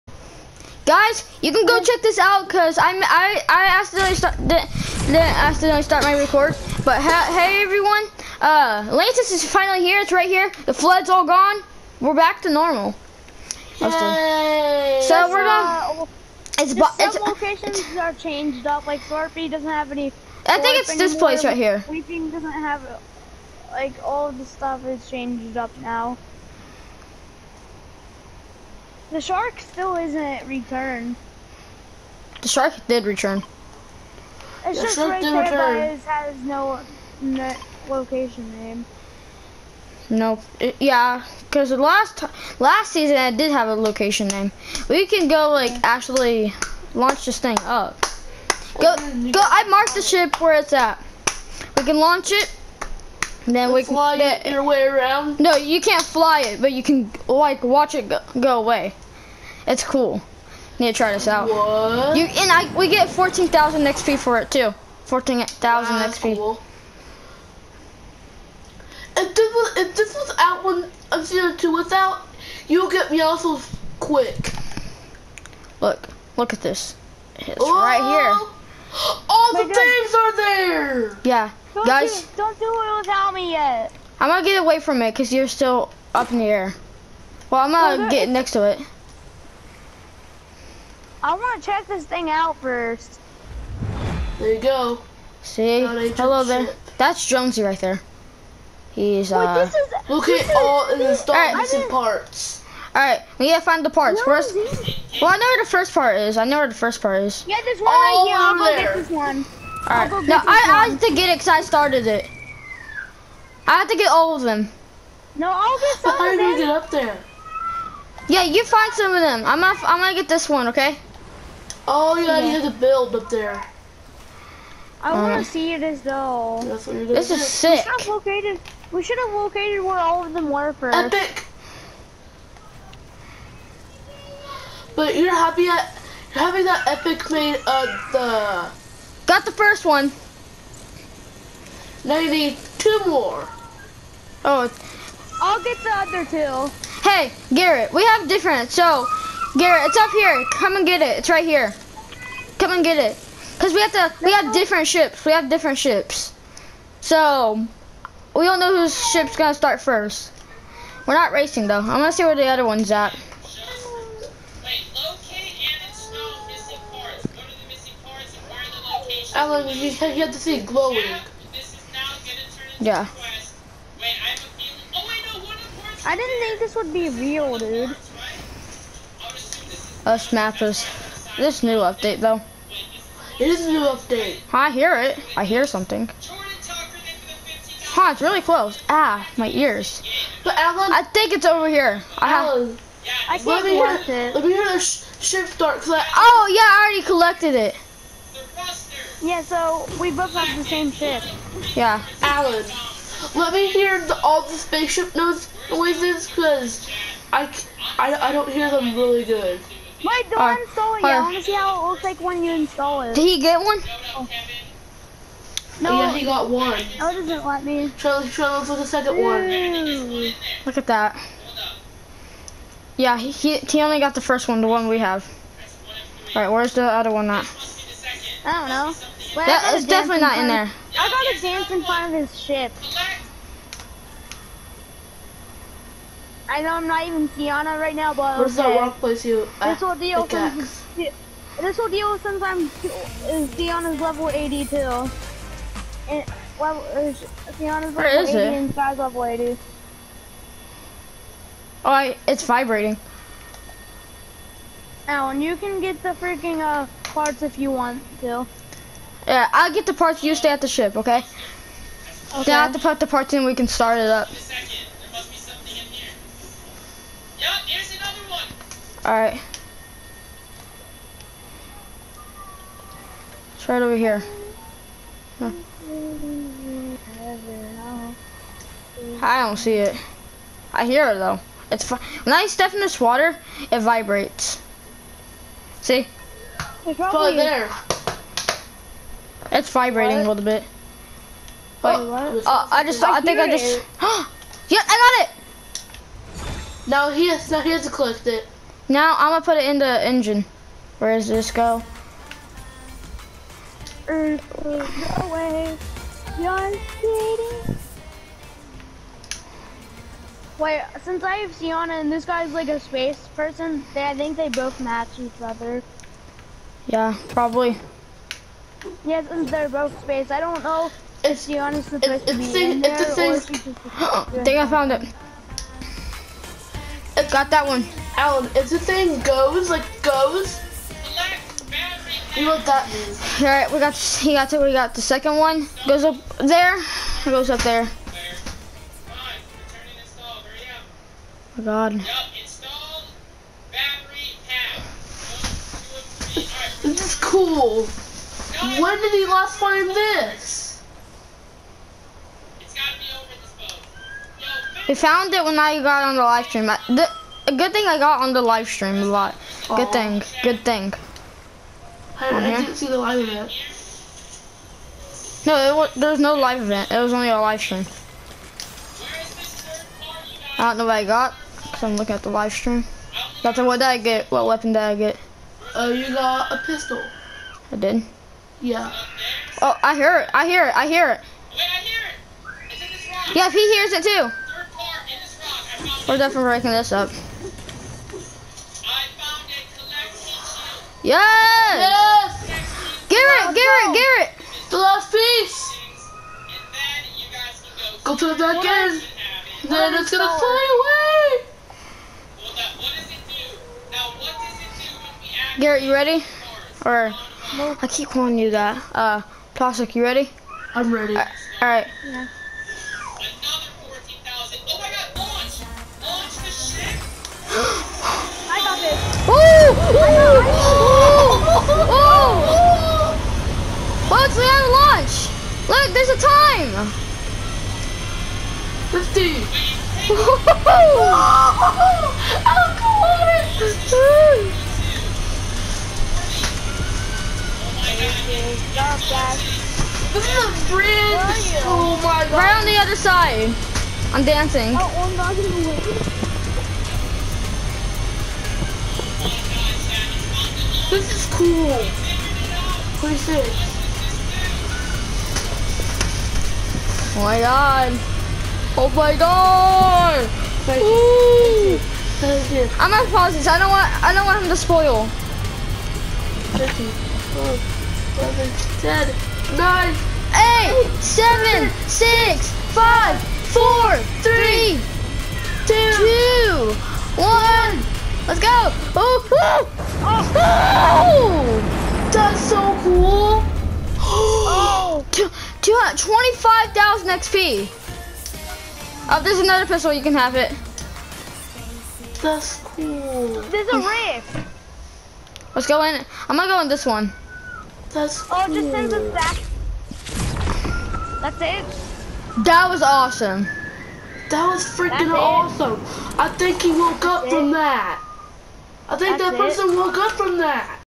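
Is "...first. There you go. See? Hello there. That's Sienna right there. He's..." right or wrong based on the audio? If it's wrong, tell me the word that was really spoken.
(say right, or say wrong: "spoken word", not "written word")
wrong: "Jonesy", not "Sienna".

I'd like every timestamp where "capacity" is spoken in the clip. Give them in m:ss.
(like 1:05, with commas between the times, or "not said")
not said.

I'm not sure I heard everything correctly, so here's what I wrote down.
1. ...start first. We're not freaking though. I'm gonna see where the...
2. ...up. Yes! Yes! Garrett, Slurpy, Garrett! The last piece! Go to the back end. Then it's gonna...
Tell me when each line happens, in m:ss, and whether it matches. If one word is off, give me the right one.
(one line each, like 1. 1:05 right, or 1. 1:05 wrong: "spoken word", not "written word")
1. 2:39 wrong: "racing", not "freaking"
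2. 6:26 wrong: "Garrett", not "Slurpy".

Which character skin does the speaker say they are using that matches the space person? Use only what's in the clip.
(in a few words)
Sienna.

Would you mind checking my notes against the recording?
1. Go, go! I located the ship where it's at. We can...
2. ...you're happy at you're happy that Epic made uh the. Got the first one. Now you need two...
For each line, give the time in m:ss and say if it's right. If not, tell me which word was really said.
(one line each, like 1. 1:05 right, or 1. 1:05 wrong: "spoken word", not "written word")
1. 0:48 wrong: "marked", not "located"
2. 2:15 right.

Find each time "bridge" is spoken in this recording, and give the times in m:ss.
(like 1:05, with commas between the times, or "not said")
7:20.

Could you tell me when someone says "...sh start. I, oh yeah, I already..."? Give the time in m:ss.
3:14.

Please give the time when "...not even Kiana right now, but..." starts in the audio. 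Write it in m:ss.
3:56.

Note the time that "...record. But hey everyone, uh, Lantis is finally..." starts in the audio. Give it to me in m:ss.
0:06.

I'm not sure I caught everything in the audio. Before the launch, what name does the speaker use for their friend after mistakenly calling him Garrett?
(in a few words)
Plastic.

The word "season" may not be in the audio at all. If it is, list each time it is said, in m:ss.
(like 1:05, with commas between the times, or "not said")
0:42, 1:11.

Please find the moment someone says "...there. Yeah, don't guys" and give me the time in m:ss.
1:20.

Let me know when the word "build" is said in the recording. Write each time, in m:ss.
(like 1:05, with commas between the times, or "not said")
2:02.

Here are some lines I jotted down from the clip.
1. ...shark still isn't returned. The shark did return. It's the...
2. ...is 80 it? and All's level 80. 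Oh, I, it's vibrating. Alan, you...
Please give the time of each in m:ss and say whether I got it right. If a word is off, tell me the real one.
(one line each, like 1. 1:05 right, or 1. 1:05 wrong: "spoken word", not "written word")
1. 0:29 right
2. 4:07 wrong: "Sky", not "All".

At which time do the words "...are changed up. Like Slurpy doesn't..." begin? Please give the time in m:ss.
0:17.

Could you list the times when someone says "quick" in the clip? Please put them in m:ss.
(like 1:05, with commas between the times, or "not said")
1:13.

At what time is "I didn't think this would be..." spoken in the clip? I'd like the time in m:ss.
2:56.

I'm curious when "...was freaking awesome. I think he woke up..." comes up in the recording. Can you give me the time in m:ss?
8:24.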